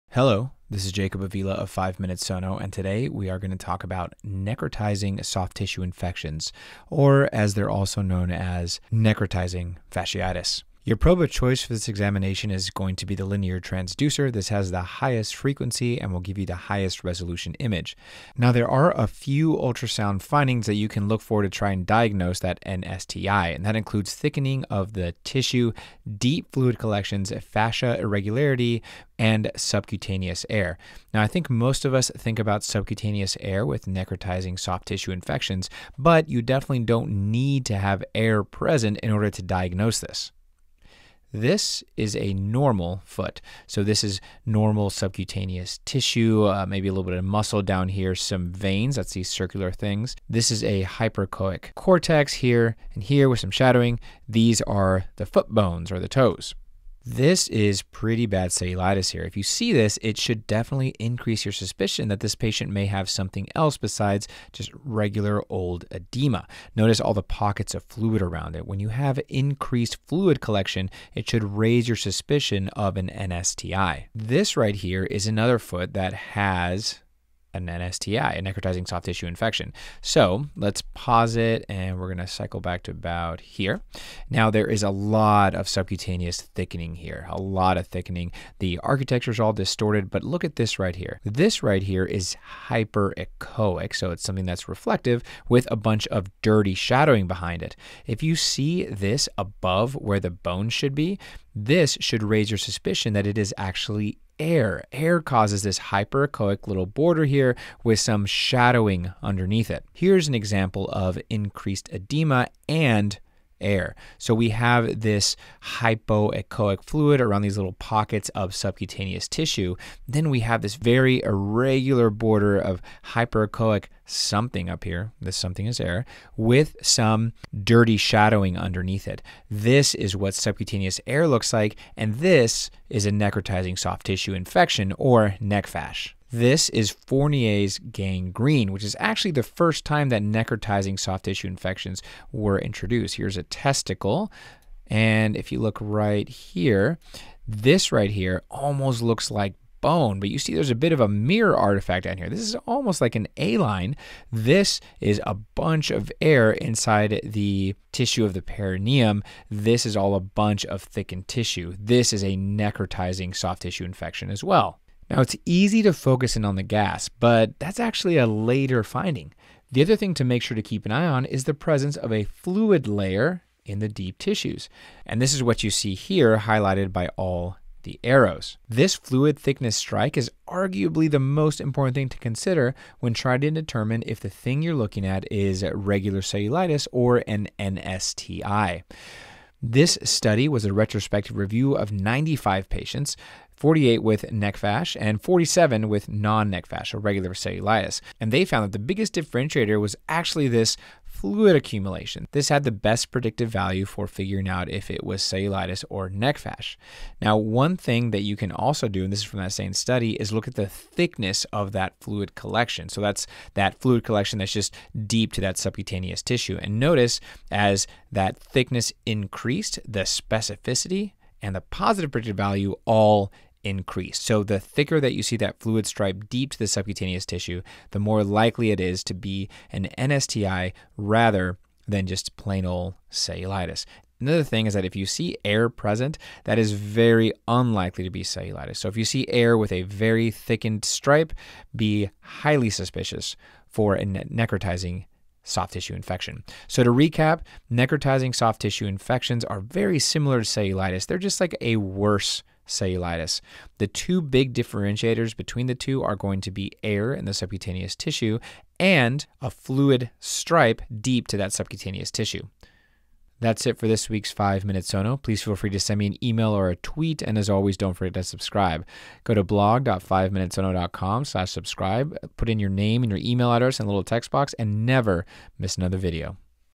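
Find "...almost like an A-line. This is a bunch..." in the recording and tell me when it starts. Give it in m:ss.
2:32.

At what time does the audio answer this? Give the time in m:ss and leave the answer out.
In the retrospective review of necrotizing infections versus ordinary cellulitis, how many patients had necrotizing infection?
3:13.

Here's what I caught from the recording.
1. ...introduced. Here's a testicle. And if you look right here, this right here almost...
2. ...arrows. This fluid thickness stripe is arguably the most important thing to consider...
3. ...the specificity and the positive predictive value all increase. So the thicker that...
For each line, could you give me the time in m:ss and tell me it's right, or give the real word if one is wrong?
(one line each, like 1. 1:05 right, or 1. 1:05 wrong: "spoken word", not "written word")
1. 2:22 right
2. 2:58 right
3. 3:39 right.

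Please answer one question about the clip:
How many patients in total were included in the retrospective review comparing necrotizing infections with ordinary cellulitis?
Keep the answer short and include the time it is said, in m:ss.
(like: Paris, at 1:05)
95, at 3:11.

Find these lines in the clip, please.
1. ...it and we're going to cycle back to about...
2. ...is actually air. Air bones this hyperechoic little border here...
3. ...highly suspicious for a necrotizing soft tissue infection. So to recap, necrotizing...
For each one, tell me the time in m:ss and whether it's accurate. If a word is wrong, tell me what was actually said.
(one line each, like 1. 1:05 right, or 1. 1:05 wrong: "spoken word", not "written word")
1. 1:21 right
2. 1:43 wrong: "causes", not "bones"
3. 4:02 right.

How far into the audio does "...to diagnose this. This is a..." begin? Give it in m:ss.
0:39.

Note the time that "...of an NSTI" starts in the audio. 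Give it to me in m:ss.
1:12.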